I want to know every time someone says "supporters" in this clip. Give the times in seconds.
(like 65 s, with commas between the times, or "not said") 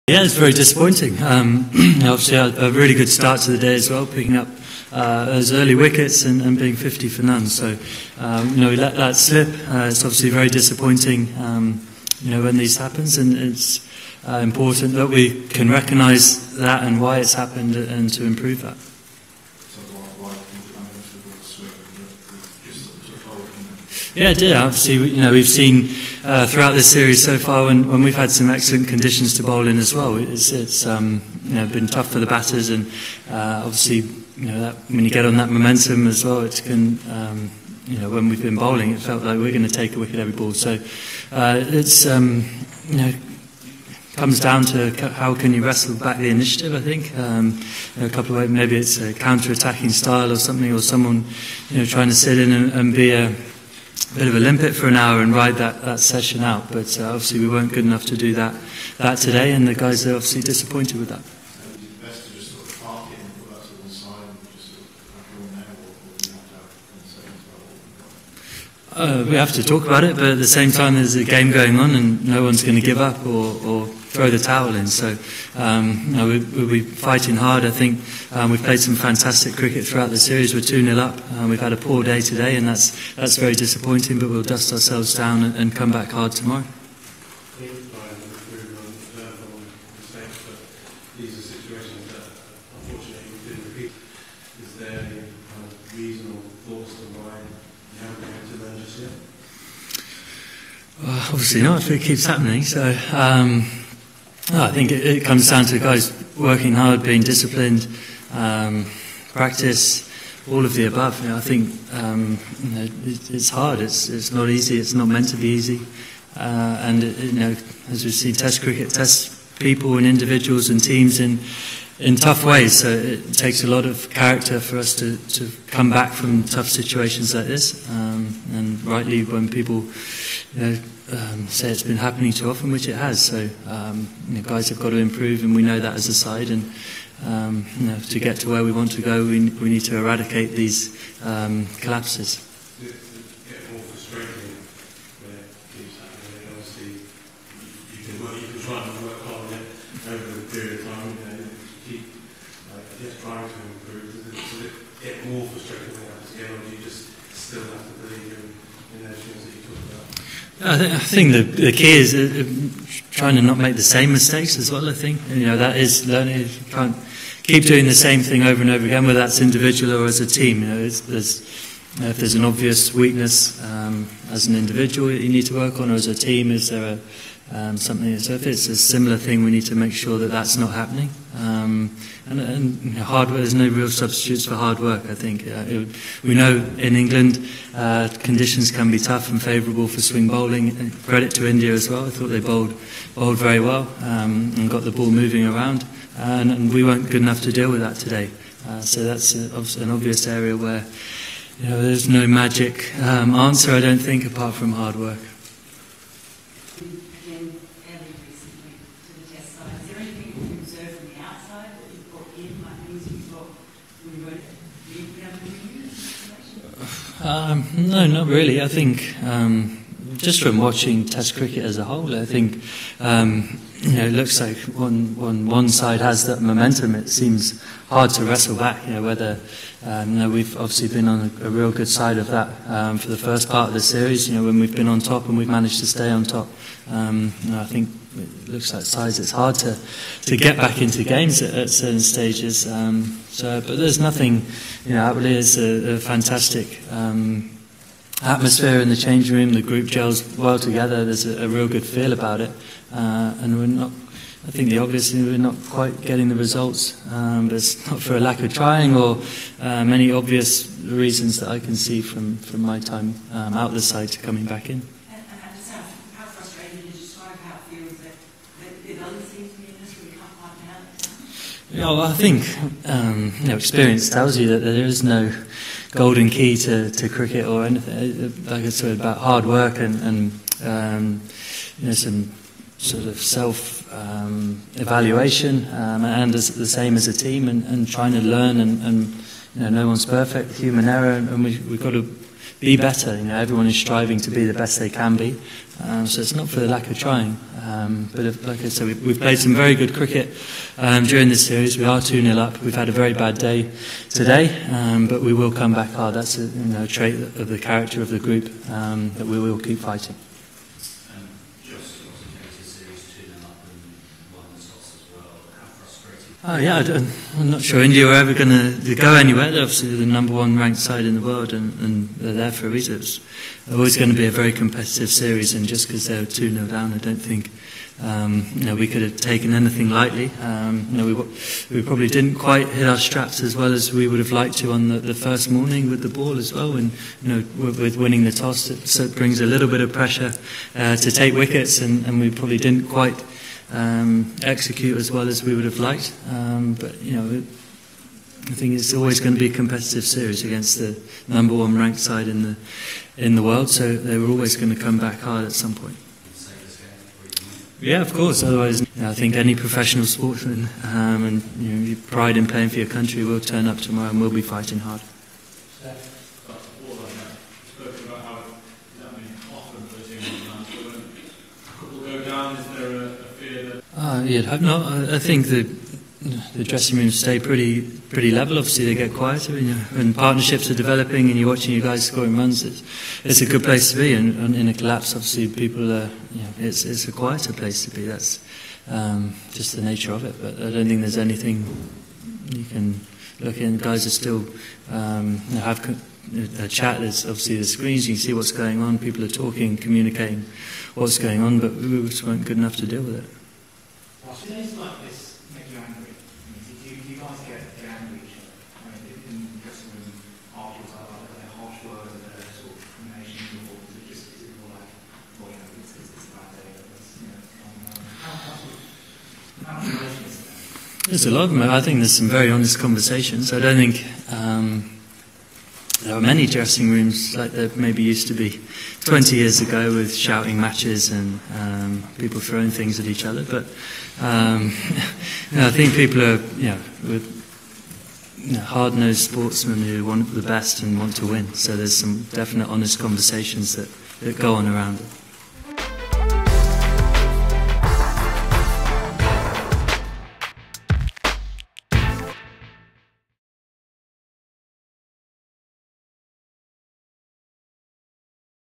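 not said.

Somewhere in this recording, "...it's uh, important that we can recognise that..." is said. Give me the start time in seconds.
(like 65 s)
13 s.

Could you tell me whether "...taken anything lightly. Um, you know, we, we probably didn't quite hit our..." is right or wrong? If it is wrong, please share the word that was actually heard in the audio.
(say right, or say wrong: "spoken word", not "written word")
right.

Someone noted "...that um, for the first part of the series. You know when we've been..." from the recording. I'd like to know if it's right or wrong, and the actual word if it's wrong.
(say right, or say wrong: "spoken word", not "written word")
right.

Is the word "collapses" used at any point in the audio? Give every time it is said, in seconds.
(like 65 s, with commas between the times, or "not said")
141 s, 384 s.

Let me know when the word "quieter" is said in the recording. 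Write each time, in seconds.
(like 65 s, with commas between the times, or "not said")
379 s, 387 s.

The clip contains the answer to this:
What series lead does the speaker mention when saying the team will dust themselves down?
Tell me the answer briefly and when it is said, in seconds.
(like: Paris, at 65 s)
2-0 up, at 80 s.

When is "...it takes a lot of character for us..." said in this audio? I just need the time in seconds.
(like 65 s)
122 s.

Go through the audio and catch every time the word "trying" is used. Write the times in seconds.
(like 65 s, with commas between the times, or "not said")
51 s, 153 s, 163 s, 258 s, 287 s, 296 s.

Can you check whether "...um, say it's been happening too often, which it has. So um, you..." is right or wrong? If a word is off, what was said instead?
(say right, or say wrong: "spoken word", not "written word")
right.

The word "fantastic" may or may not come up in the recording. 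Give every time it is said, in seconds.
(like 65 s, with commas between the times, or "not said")
78 s, 245 s.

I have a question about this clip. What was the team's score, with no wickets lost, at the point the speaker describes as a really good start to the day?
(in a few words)
50 for none.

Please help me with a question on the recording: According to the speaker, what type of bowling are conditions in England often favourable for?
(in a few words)
swing bowling.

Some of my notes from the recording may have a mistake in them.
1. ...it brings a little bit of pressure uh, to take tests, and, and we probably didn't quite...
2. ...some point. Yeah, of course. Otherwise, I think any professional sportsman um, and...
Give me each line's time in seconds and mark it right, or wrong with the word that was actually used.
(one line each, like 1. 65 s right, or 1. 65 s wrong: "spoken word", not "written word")
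1. 339 s wrong: "wickets", not "tests"
2. 355 s right.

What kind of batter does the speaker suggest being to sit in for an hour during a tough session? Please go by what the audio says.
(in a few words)
a limpet.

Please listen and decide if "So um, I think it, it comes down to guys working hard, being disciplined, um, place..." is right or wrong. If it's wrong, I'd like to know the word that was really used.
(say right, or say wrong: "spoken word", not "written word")
wrong: "practice", not "place".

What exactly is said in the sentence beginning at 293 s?
You know, everyone is striving to be the best they can be.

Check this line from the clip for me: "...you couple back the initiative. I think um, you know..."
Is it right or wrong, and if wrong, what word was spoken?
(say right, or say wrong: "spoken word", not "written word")
wrong: "wrestle", not "couple".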